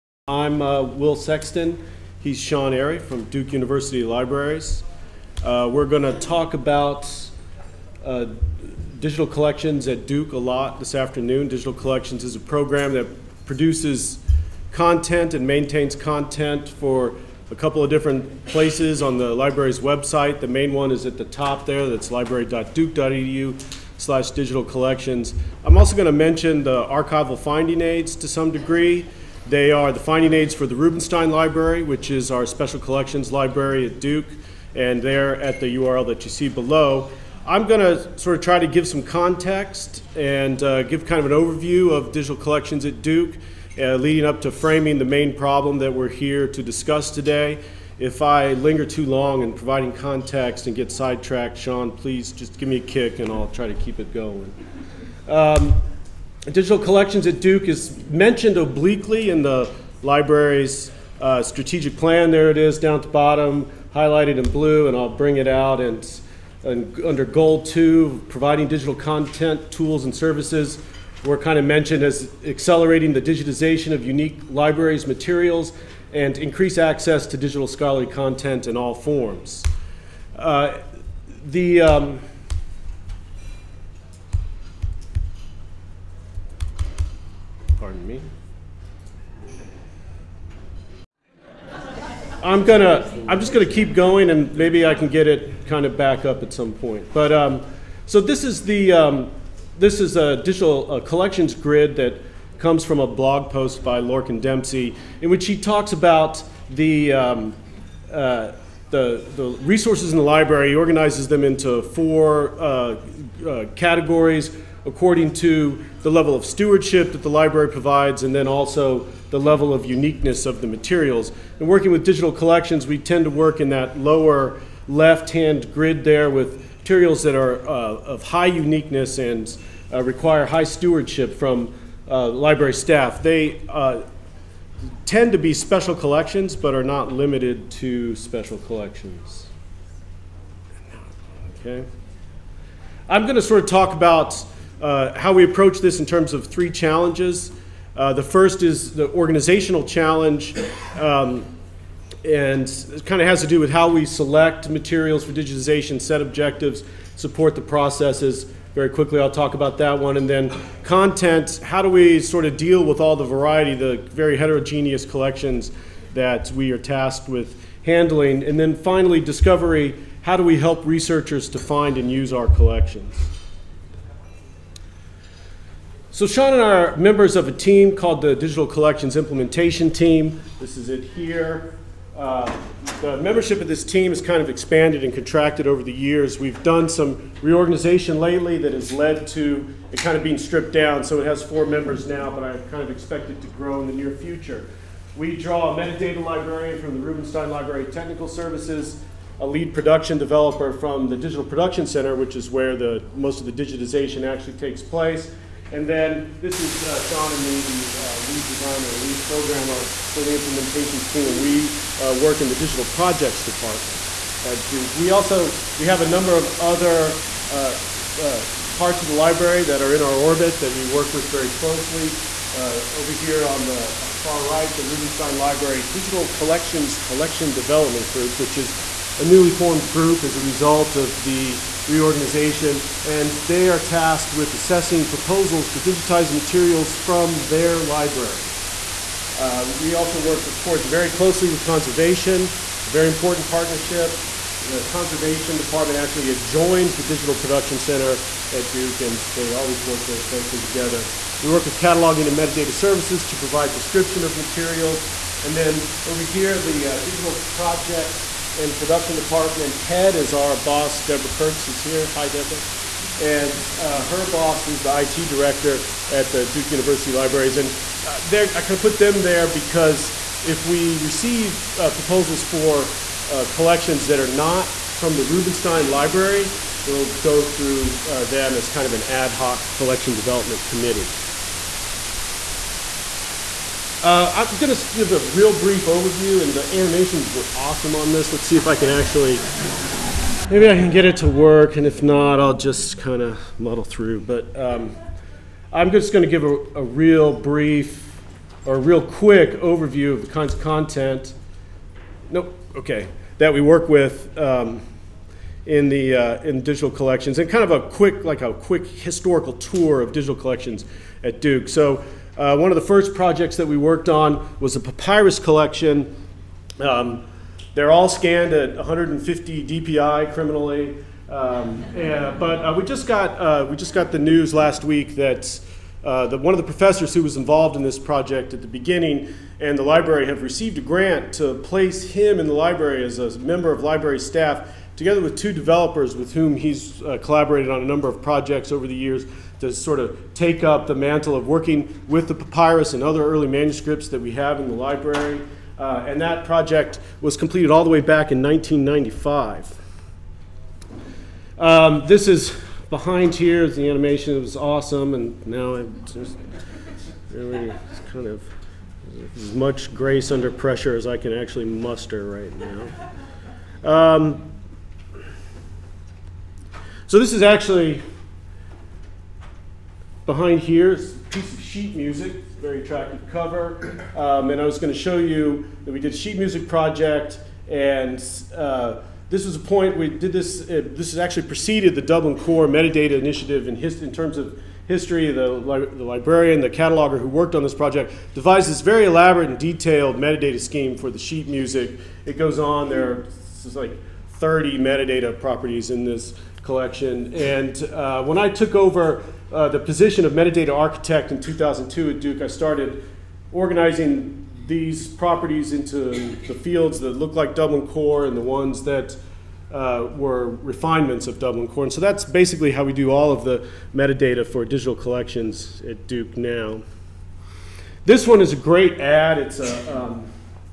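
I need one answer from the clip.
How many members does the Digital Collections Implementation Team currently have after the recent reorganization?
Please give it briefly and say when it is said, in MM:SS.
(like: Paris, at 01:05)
4, at 03:11.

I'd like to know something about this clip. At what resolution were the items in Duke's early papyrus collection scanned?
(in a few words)
150 DPI.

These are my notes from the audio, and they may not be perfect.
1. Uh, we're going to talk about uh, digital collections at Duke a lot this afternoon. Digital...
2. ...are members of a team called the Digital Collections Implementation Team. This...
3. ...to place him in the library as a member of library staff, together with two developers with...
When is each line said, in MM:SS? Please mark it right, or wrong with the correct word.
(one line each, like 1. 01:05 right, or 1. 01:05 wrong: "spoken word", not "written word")
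1. 00:05 right
2. 02:56 right
3. 05:31 right.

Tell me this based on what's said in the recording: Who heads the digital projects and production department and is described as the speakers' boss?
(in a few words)
Deborah Kurtz.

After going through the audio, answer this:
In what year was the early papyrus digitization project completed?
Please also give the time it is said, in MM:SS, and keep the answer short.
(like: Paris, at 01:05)
1995, at 05:48.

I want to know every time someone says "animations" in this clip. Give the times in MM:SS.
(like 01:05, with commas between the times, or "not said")
04:46, 05:53.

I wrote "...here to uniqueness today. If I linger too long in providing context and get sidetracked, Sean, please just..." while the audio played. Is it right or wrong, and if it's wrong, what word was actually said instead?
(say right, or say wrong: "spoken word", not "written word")
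wrong: "discuss", not "uniqueness".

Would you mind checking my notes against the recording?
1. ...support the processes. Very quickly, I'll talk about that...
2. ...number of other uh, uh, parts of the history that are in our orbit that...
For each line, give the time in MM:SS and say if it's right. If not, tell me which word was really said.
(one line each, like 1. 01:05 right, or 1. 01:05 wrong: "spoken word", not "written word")
1. 02:37 right
2. 03:36 wrong: "library", not "history".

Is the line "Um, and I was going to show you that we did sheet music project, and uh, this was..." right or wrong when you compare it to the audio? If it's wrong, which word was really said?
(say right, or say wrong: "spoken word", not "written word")
right.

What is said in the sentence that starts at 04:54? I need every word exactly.
But um, I'm just going to give a, a, real brief or a real quick overview of the kinds of content.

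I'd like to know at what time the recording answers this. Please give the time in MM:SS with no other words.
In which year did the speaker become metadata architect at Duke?
06:41.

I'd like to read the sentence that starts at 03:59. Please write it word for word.
Uh, we also work, of course, very closely with conservation, a very important partnership.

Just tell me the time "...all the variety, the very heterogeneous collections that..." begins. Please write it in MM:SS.
02:42.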